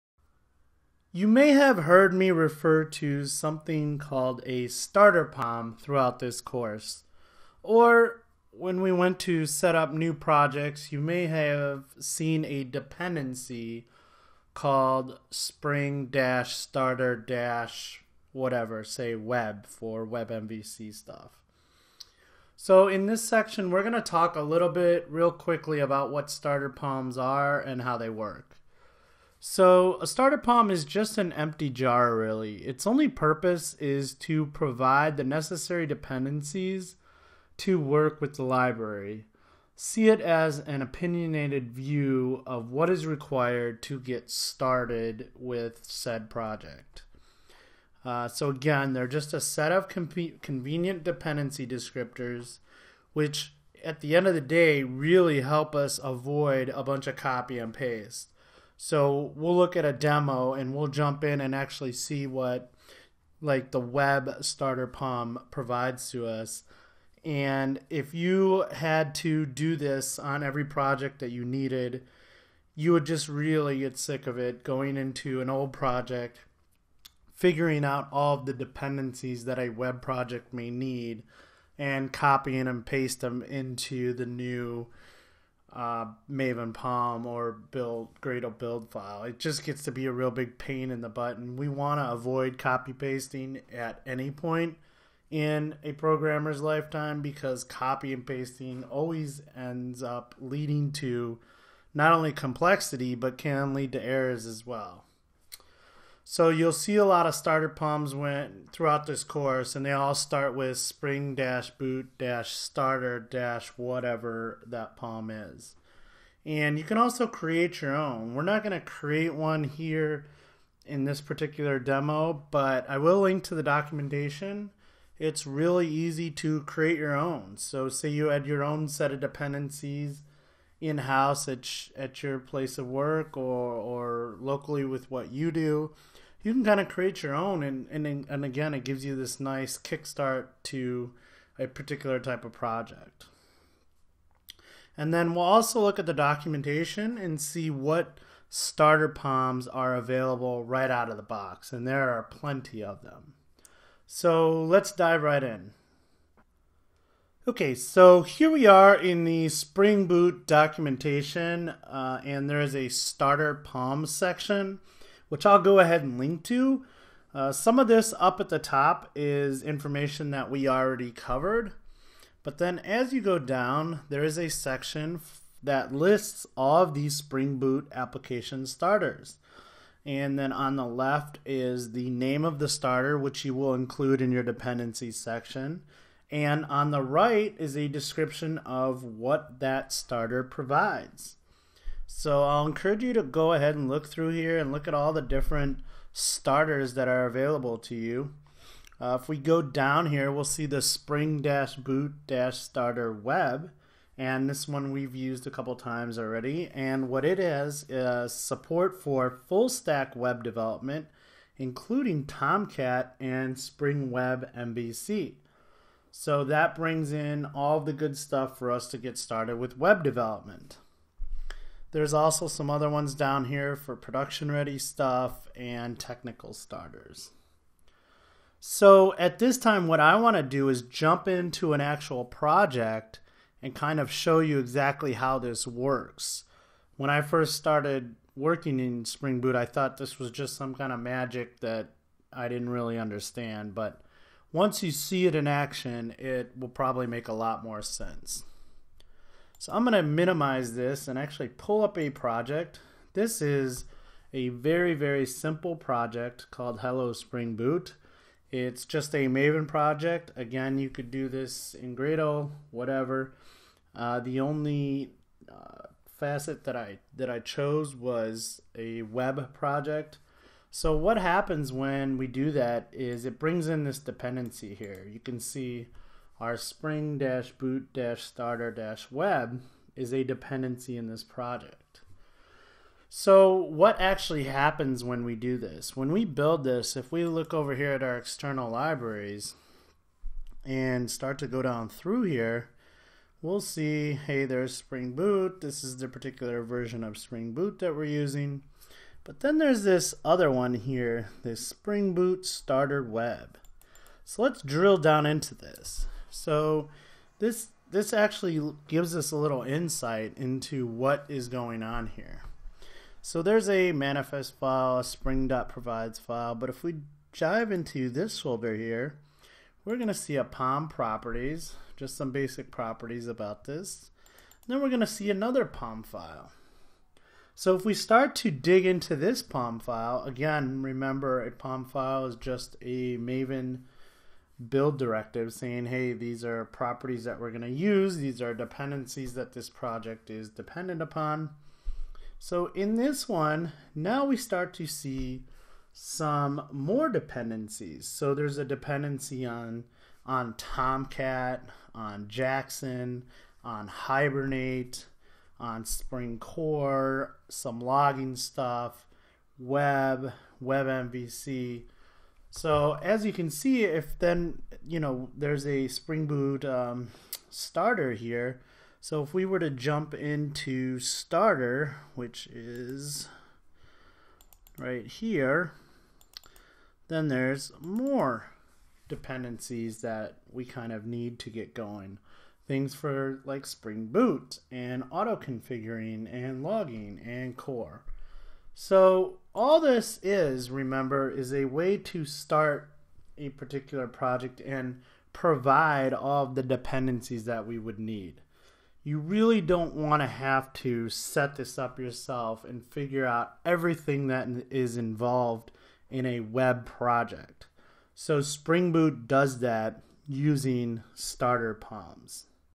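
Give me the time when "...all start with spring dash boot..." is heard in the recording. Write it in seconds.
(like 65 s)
109 s.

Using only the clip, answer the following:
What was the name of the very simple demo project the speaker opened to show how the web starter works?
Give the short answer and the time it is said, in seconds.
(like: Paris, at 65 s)
Hello Spring Boot, at 256 s.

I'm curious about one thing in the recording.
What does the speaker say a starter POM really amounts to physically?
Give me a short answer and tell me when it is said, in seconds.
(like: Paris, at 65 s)
an empty jar, at 31 s.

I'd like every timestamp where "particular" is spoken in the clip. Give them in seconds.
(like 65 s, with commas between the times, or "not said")
121 s, 141 s, 296 s, 393 s.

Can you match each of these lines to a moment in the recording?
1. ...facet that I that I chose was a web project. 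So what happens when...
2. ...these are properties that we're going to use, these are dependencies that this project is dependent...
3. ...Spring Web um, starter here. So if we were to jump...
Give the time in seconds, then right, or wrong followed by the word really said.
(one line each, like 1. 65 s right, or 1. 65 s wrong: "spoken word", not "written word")
1. 266 s right
2. 336 s right
3. 365 s wrong: "Boot", not "Web".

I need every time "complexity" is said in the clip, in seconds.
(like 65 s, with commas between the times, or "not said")
102 s.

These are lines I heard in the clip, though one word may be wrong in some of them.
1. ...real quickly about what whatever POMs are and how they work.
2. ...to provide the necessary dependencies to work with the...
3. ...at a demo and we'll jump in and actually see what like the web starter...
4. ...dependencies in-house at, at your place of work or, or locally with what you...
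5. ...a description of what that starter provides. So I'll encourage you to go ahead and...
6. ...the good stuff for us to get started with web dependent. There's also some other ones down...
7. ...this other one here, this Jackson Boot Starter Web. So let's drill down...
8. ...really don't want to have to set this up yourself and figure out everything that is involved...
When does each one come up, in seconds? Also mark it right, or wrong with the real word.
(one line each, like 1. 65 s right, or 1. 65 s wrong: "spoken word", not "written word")
1. 25 s wrong: "starter", not "whatever"
2. 34 s right
3. 59 s right
4. 129 s right
5. 187 s right
6. 217 s wrong: "development", not "dependent"
7. 299 s wrong: "Spring", not "Jackson"
8. 399 s right.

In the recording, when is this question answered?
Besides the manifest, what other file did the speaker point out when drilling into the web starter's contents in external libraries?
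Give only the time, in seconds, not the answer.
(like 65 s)
315 s.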